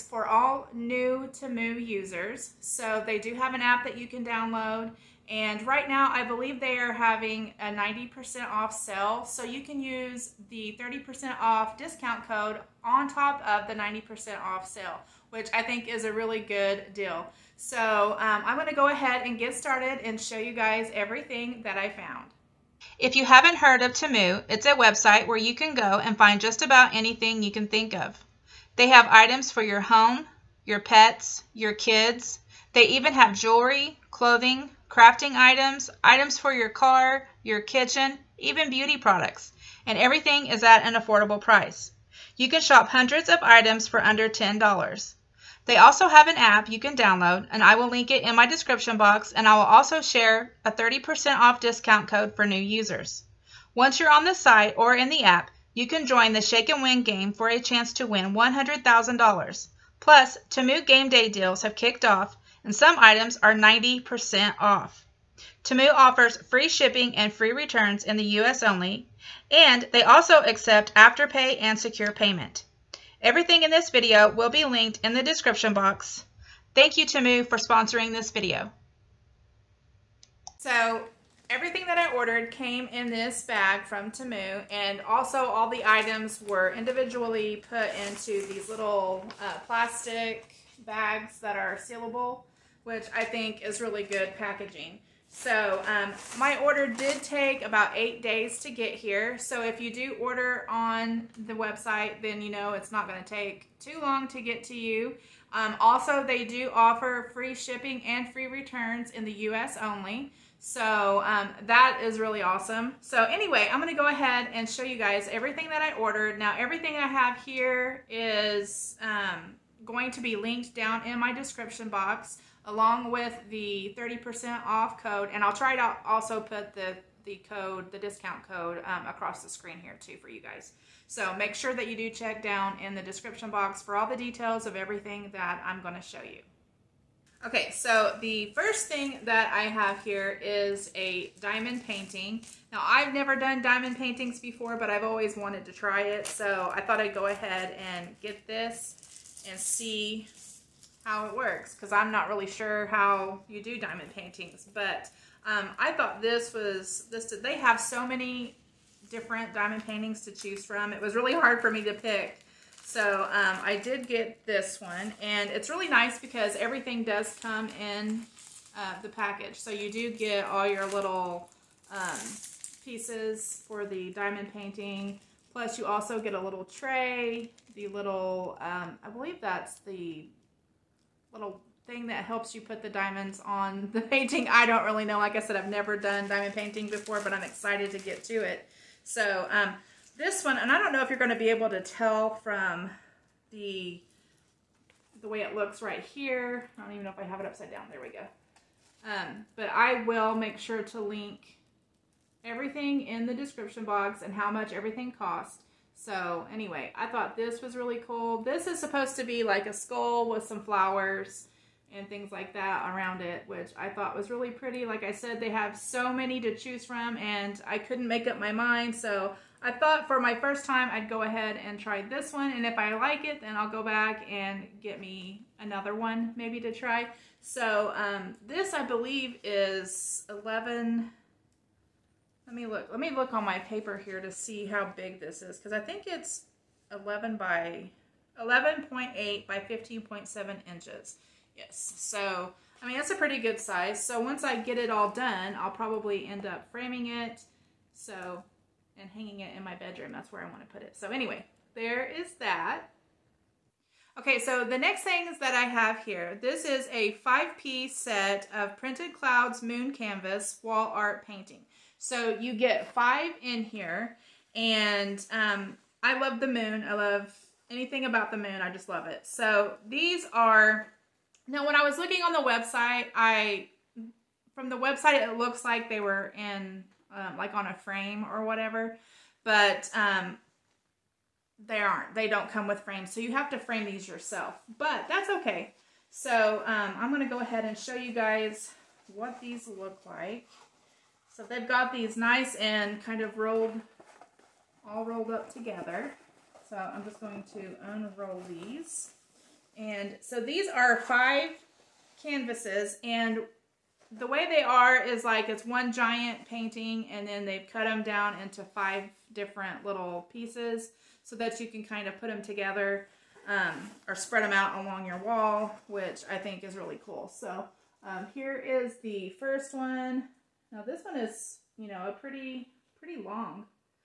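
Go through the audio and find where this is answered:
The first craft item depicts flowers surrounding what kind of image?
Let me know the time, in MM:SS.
03:29.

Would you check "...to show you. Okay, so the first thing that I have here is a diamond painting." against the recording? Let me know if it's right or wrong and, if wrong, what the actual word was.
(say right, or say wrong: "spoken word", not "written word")
right.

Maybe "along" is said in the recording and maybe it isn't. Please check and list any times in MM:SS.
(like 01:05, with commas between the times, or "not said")
02:02, 05:14.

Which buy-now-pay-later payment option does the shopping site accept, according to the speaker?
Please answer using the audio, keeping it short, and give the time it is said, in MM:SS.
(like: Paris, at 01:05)
Afterpay, at 01:10.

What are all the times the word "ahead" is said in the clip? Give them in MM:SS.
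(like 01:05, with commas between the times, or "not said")
00:18, 01:54, 02:27, 03:41, 04:47.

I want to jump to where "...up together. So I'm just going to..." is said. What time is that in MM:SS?
04:55.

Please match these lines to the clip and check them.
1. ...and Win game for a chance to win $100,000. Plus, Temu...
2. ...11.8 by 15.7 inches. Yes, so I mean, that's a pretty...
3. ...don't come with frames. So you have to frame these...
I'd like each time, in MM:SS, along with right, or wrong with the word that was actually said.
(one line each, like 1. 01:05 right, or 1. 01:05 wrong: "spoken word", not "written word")
1. 00:56 right
2. 03:58 right
3. 04:42 right.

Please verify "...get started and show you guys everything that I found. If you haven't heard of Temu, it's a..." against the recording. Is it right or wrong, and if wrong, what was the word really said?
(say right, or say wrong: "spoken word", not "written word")
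right.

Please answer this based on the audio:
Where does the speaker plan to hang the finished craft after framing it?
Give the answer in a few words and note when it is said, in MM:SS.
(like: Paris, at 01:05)
bedroom, at 04:09.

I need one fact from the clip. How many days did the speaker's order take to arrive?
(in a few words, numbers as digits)
8.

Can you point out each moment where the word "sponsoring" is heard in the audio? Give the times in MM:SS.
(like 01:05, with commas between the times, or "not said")
01:17.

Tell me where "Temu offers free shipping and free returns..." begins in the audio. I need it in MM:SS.
01:05.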